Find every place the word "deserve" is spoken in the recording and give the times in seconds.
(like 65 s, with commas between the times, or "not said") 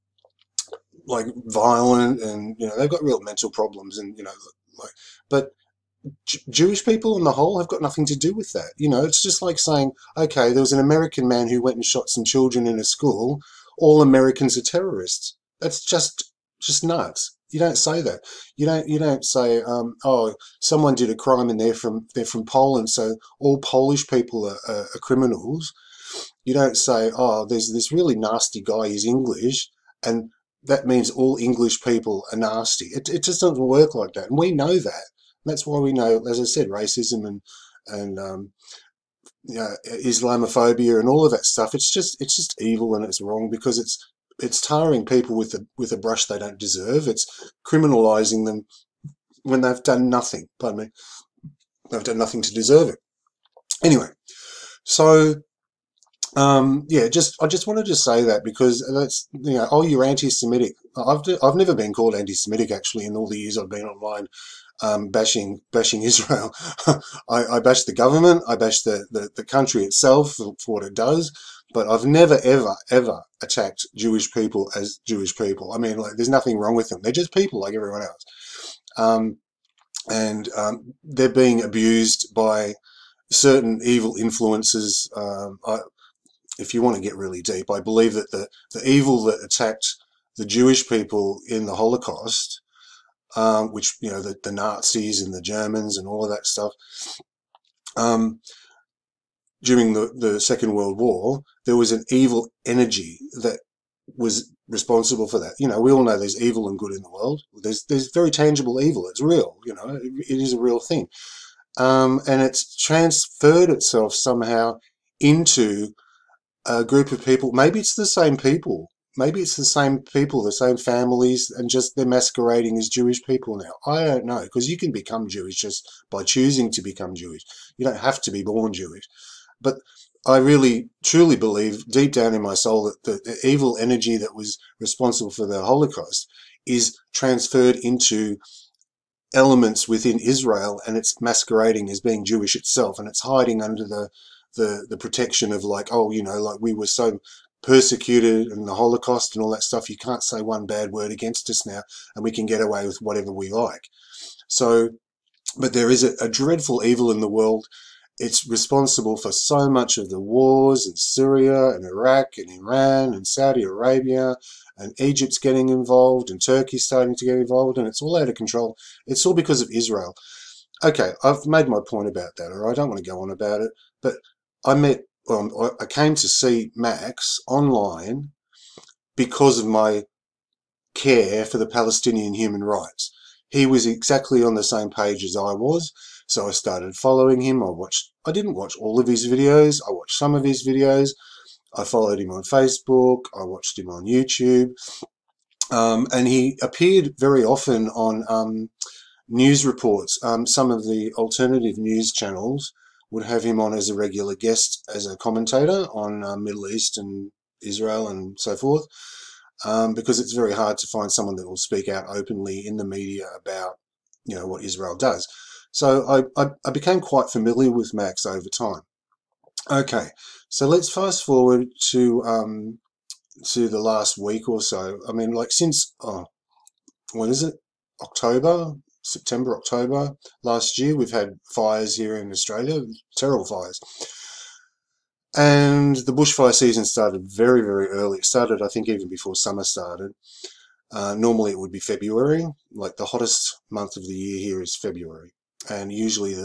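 46 s, 52 s.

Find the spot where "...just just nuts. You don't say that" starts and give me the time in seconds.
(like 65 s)
15 s.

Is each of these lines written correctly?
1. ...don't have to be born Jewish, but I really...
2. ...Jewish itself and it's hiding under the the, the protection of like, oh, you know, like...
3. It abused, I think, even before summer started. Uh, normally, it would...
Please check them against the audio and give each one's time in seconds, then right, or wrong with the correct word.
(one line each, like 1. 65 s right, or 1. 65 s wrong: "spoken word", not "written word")
1. 127 s right
2. 142 s right
3. 238 s wrong: "started", not "abused".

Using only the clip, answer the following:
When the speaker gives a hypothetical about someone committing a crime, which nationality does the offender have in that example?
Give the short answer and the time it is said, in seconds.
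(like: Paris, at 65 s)
Polish, at 22 s.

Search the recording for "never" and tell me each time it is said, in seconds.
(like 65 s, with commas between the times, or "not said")
61 s, 72 s.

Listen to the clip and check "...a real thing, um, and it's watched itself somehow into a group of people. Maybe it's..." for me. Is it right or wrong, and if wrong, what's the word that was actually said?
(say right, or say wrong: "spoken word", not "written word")
wrong: "transferred", not "watched".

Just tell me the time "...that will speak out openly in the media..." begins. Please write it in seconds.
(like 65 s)
211 s.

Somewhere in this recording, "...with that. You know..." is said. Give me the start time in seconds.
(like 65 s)
8 s.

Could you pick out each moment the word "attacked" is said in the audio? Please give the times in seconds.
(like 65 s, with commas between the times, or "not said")
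73 s, 89 s.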